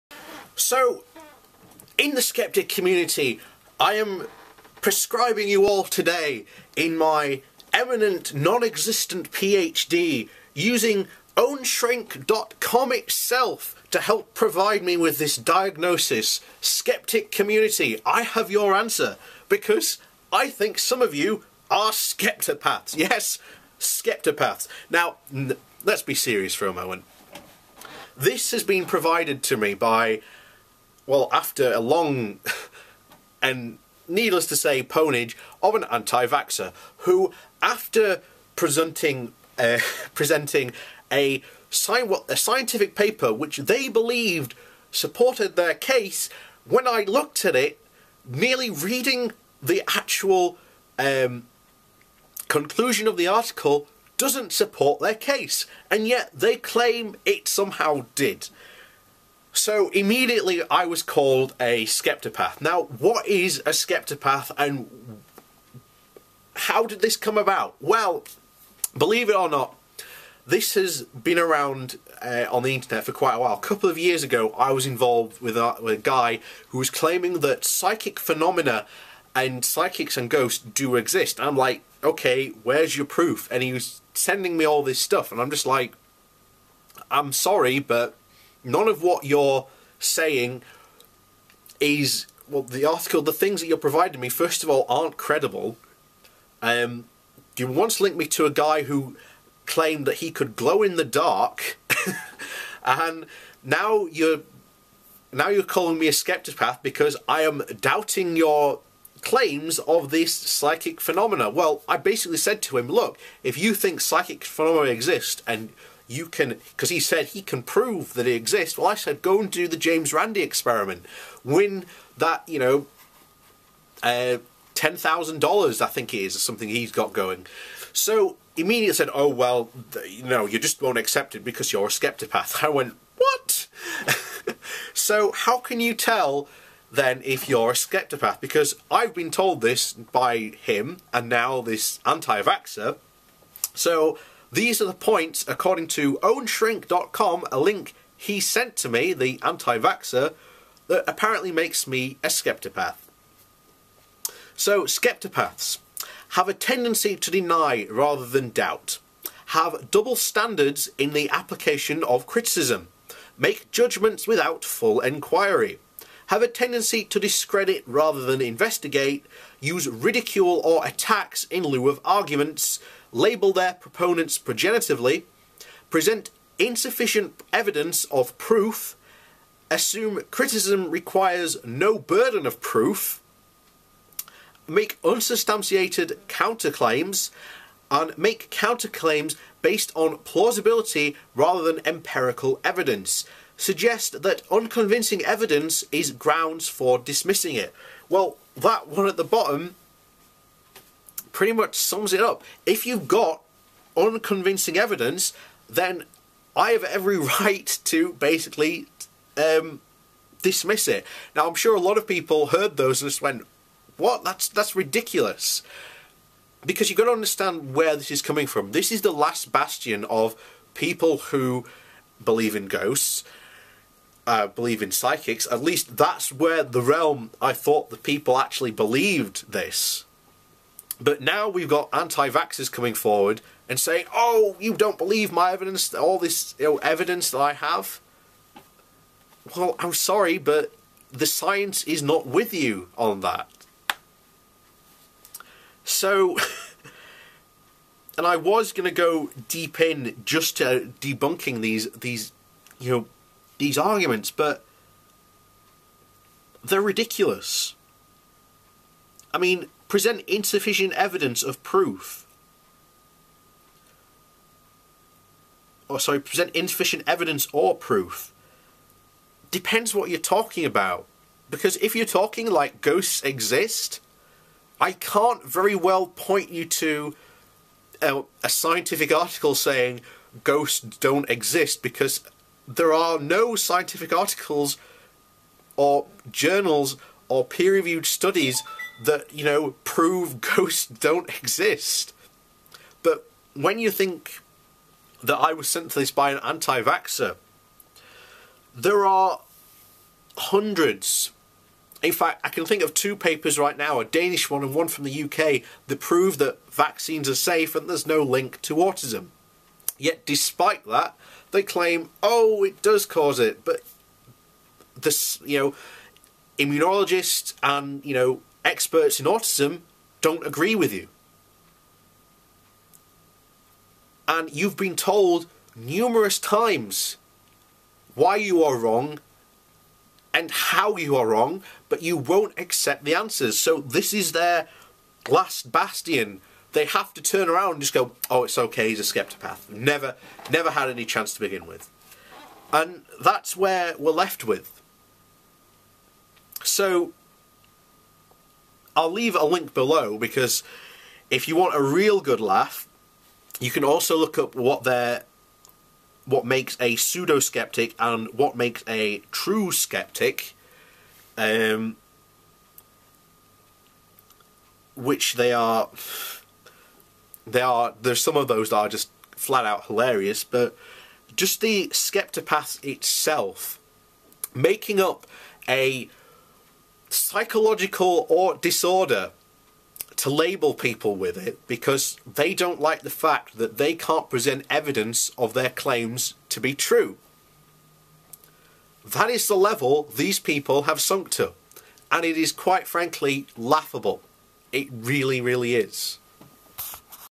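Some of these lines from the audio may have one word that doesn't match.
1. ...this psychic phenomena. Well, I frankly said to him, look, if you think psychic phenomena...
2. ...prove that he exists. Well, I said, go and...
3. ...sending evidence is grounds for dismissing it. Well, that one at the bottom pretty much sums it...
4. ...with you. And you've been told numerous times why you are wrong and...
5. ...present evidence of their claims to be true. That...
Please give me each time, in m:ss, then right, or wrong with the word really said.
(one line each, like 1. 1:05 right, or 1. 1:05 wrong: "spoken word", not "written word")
1. 1:50 wrong: "basically", not "frankly"
2. 1:57 right
3. 3:14 wrong: "unconvincing", not "sending"
4. 5:20 right
5. 6:24 right.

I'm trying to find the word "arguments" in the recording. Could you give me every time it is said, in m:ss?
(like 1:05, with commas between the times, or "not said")
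2:52, 4:13.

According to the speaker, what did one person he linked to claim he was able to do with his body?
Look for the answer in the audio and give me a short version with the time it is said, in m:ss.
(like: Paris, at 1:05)
glow in the dark, at 1:40.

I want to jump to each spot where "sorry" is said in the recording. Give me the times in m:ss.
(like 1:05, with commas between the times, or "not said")
1:27, 3:59, 4:25.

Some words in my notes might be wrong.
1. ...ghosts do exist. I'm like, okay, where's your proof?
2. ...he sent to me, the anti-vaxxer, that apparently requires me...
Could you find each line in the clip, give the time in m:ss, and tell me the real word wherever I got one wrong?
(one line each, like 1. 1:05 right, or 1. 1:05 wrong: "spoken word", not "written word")
1. 1:20 right
2. 2:28 wrong: "makes", not "requires".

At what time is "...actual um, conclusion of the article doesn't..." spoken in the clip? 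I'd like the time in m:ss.
0:49.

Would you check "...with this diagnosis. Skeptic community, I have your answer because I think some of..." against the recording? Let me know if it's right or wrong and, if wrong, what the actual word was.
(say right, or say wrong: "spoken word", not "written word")
right.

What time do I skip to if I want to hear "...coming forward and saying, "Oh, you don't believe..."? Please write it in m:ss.
3:52.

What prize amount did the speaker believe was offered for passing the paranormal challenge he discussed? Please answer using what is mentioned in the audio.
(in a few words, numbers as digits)
$10,000.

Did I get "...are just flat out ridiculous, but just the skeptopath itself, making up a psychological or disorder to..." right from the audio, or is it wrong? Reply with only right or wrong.
wrong.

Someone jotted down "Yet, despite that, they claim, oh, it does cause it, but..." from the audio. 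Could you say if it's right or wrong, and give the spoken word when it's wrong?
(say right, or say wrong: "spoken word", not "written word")
right.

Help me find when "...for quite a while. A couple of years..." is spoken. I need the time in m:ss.
1:13.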